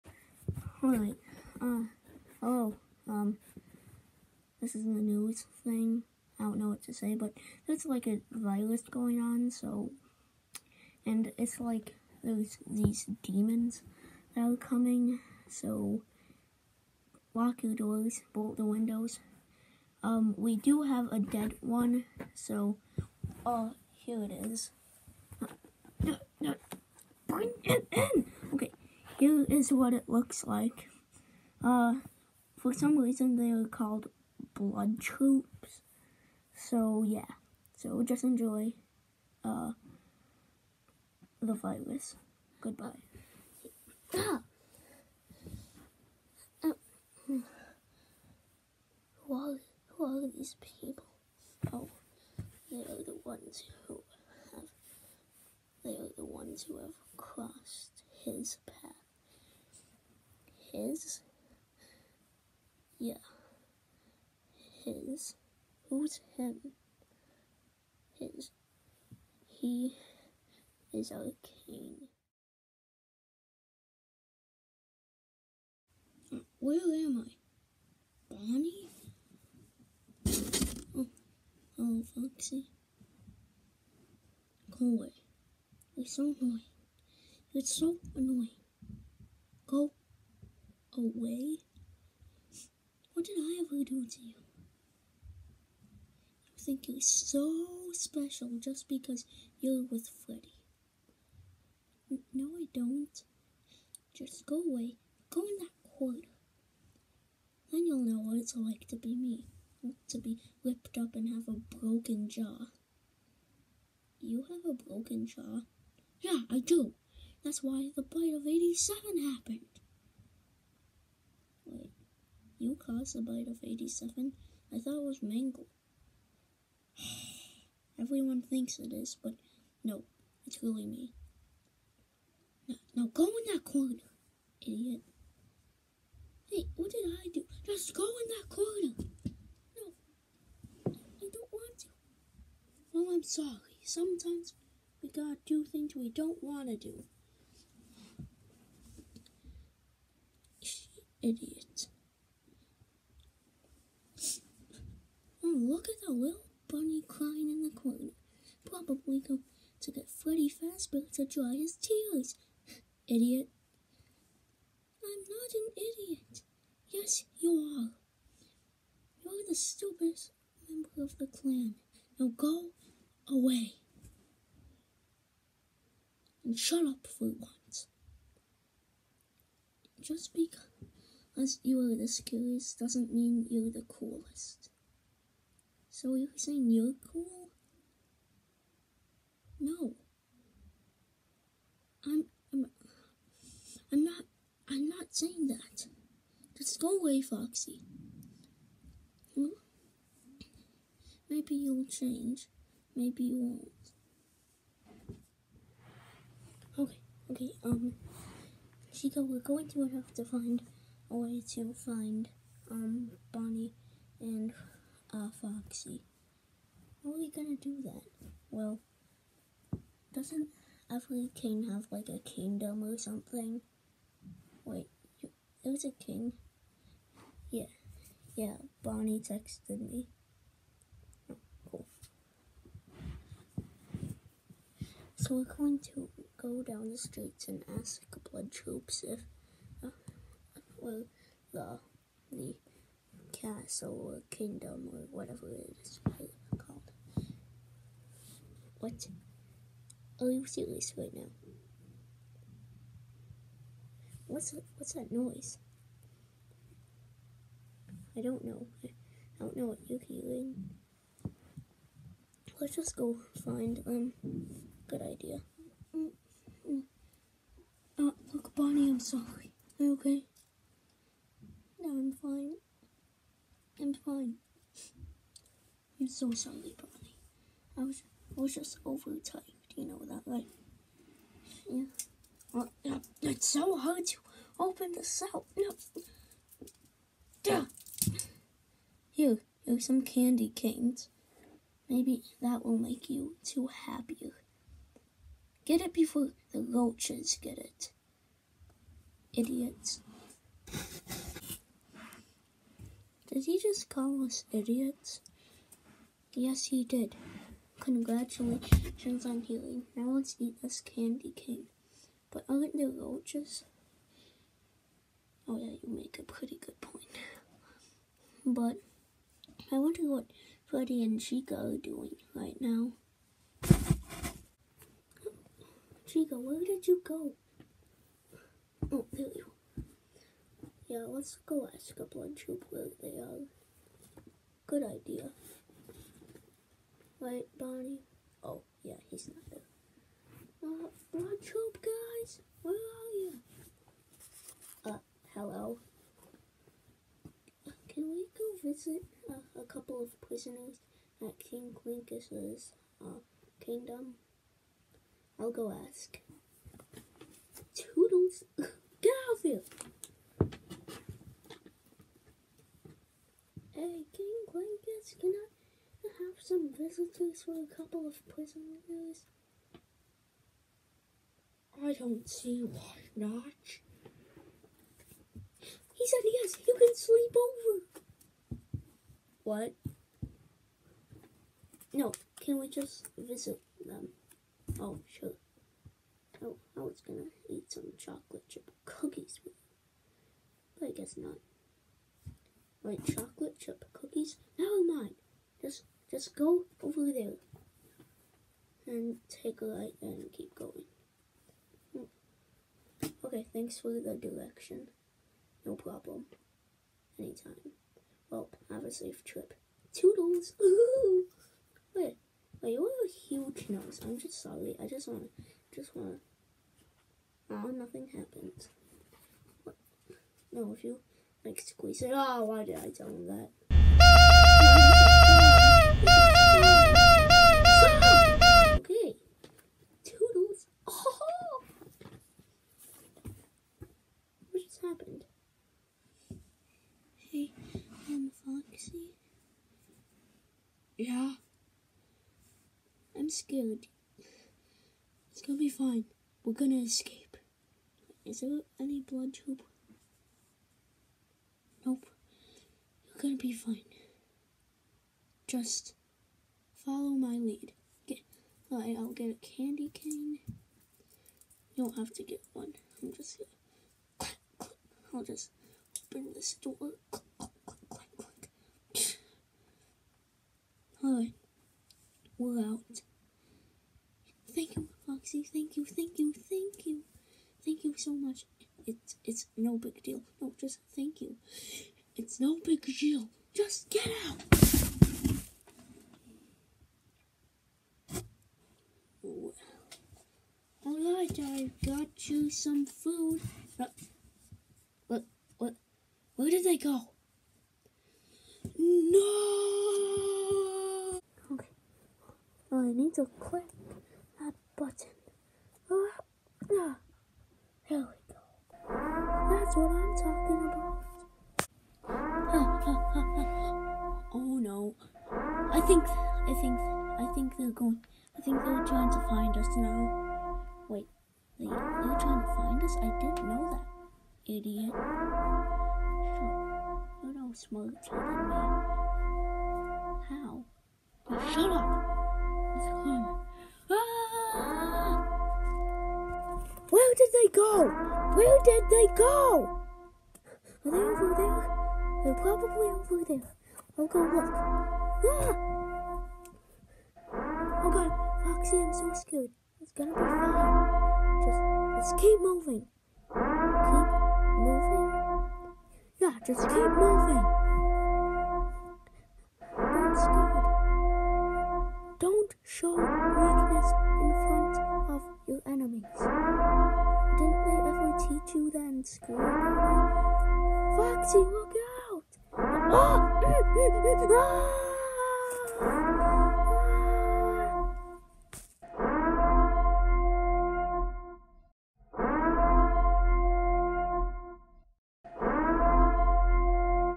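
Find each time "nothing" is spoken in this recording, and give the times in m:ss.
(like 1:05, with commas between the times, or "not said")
6:57.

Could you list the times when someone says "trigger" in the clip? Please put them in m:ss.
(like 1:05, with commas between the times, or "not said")
not said.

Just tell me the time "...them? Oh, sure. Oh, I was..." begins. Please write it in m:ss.
6:23.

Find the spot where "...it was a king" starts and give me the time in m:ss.
3:45.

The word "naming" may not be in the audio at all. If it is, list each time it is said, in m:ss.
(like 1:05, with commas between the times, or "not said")
not said.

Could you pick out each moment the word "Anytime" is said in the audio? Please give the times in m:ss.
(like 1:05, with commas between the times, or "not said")
6:47.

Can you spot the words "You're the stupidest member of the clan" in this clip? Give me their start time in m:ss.
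2:49.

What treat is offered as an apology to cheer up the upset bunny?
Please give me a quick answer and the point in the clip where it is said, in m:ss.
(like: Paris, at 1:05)
Candy canes, at 4:50.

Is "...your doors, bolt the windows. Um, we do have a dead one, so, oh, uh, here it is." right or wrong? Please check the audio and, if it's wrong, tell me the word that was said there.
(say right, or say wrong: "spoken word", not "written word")
right.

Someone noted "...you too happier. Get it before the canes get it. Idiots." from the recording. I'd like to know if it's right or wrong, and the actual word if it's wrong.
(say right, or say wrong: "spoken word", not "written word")
wrong: "roaches", not "canes".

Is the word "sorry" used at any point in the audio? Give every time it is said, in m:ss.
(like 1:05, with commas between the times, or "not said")
2:23, 4:28, 4:36, 6:54.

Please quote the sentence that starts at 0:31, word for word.
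Uh, for some reason, they are called blood troops.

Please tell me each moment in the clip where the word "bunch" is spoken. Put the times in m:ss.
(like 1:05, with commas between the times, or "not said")
5:32, 5:41.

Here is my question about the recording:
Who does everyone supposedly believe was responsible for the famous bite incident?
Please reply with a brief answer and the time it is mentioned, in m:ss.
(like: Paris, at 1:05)
Mangle, at 2:05.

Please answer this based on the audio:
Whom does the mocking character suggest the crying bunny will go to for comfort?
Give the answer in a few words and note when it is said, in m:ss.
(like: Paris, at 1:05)
Freddy Fazbear, at 2:40.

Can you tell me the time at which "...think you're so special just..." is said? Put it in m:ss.
1:36.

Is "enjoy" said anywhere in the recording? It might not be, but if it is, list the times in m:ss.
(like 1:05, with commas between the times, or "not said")
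0:38.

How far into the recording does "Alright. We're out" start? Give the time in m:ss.
7:51.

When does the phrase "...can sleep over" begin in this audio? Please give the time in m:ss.
6:16.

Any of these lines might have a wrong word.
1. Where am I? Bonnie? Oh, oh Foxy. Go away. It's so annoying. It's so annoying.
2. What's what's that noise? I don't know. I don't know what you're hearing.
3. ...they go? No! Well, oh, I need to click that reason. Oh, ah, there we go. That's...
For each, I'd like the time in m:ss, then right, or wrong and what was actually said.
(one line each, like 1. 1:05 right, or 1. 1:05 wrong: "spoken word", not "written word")
1. 1:16 right
2. 4:14 right
3. 8:16 wrong: "button", not "reason".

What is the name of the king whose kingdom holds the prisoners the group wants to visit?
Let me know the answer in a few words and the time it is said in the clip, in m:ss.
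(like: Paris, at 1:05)
King Clinkus, at 5:51.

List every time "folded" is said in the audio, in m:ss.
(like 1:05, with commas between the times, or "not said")
not said.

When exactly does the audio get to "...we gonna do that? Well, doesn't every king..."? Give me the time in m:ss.
3:37.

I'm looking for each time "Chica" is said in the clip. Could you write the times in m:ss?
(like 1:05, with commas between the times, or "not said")
3:28, 5:21, 5:26.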